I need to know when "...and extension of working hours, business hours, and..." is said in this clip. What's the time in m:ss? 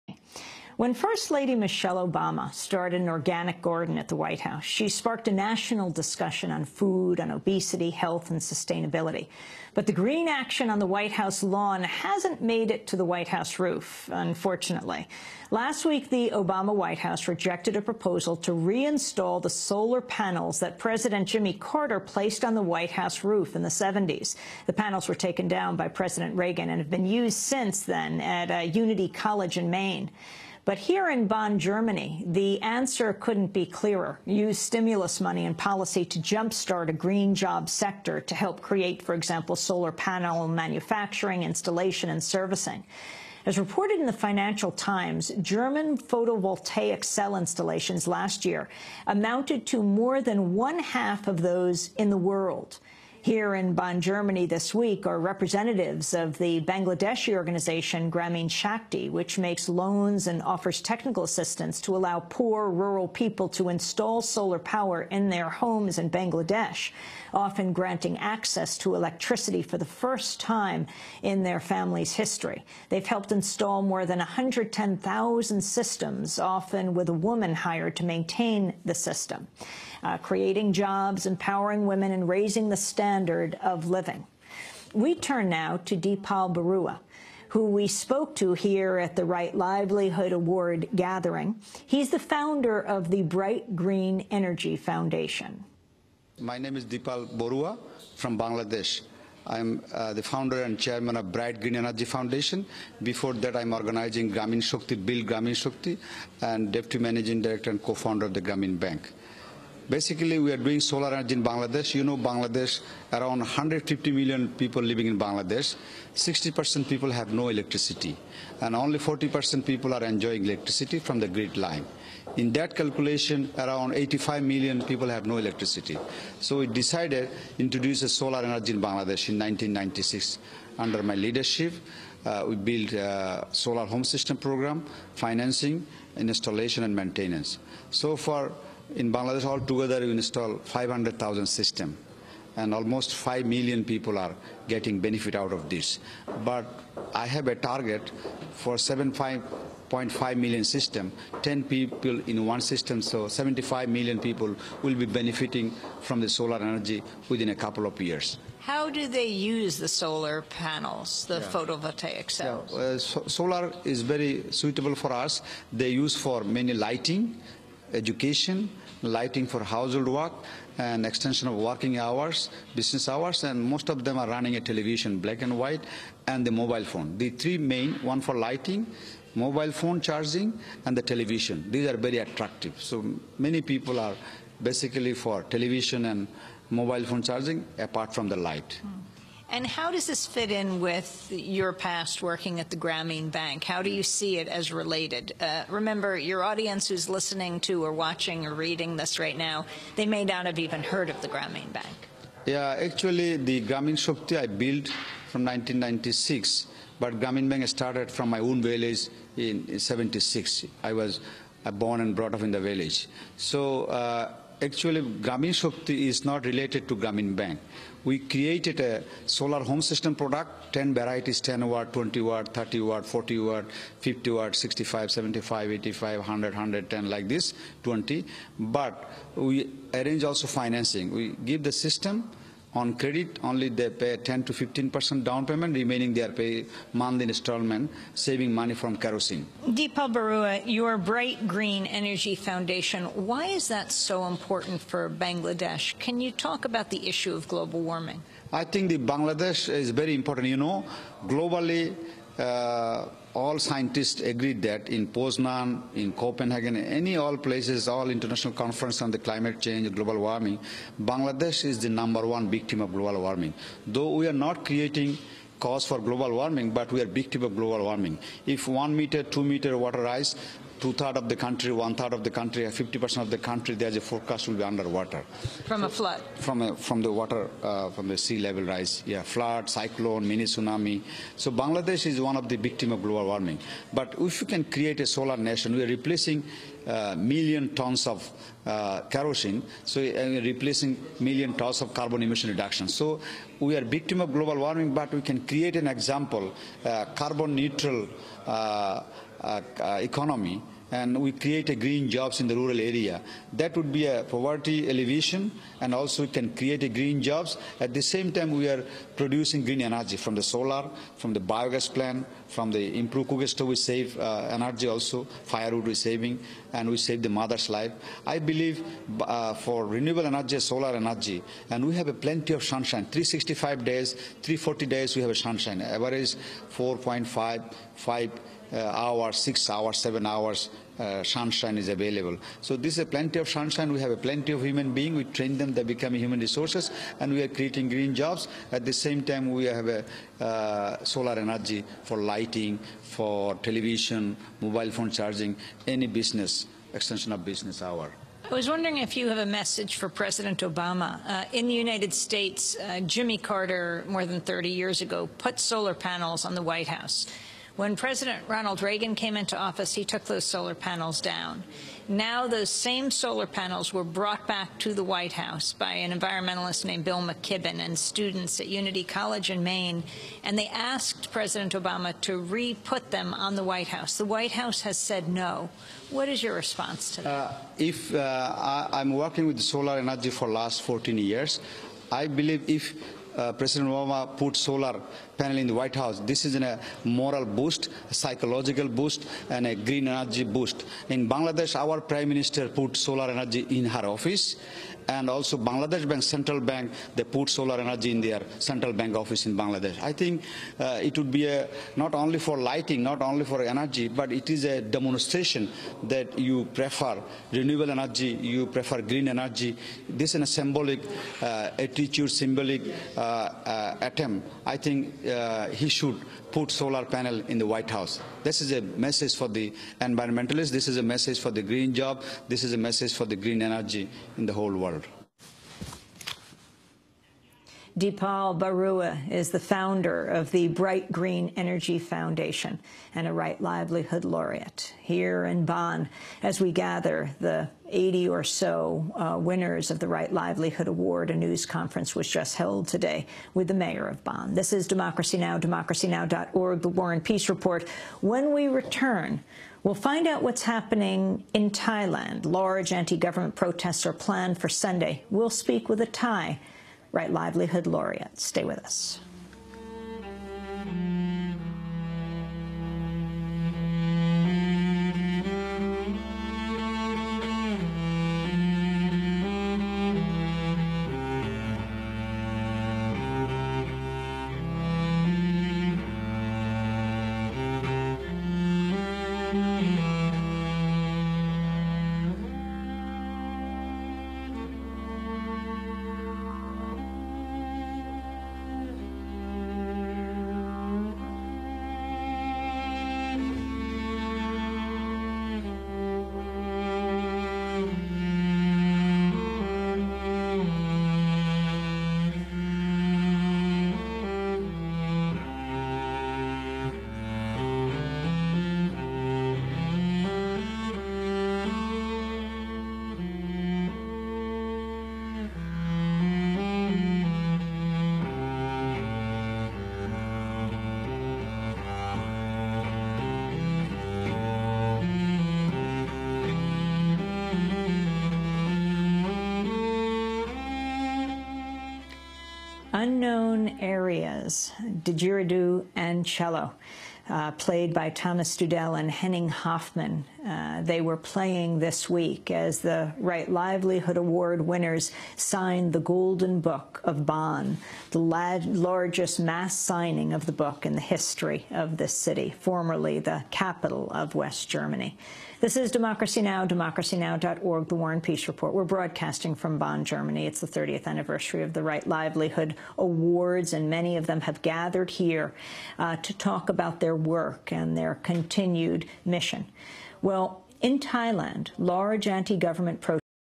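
2:50.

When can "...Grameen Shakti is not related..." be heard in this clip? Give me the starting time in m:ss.
3:35.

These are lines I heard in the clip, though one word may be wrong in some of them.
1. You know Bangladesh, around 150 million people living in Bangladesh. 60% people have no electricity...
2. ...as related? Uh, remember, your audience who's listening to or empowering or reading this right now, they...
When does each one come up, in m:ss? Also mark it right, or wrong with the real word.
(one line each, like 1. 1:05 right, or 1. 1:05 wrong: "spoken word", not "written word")
1. 1:51 right
2. 3:14 wrong: "watching", not "empowering".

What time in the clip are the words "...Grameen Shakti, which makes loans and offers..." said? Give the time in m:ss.
0:58.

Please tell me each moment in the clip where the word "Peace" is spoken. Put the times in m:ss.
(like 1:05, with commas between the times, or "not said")
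7:27, 9:18.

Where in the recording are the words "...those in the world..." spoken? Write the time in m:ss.
0:51.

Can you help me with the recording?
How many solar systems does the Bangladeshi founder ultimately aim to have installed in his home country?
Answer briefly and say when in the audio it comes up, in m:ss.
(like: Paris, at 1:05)
7.5 million, at 2:28.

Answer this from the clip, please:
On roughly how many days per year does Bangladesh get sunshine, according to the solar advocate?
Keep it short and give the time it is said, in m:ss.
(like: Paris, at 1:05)
340, at 5:24.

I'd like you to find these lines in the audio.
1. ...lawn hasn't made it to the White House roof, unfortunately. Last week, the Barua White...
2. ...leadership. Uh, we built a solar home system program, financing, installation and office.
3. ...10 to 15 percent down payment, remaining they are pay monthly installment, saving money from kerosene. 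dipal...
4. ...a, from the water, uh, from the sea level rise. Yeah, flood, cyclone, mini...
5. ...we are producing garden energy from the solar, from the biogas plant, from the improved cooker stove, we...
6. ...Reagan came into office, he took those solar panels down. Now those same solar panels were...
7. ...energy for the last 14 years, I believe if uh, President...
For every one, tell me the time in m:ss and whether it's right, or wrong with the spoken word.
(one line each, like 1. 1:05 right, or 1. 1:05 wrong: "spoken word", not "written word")
1. 0:11 wrong: "Obama", not "Barua"
2. 2:11 wrong: "maintenance", not "office"
3. 3:54 right
4. 4:36 right
5. 5:08 wrong: "green", not "garden"
6. 5:58 right
7. 6:19 right.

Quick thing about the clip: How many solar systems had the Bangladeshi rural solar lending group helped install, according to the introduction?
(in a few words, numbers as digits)
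110,000.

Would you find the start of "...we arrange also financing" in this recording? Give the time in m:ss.
3:49.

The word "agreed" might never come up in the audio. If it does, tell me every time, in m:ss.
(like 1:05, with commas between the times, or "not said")
4:14.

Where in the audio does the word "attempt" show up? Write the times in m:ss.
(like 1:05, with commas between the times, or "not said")
6:54.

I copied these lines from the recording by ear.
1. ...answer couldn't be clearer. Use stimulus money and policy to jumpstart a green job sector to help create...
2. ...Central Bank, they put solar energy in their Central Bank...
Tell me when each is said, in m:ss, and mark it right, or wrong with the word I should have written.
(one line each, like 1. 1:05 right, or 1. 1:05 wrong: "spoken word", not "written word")
1. 0:32 right
2. 6:36 right.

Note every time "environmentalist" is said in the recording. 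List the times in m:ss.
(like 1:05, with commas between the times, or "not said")
6:06, 6:59.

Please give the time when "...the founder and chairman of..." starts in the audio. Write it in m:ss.
1:40.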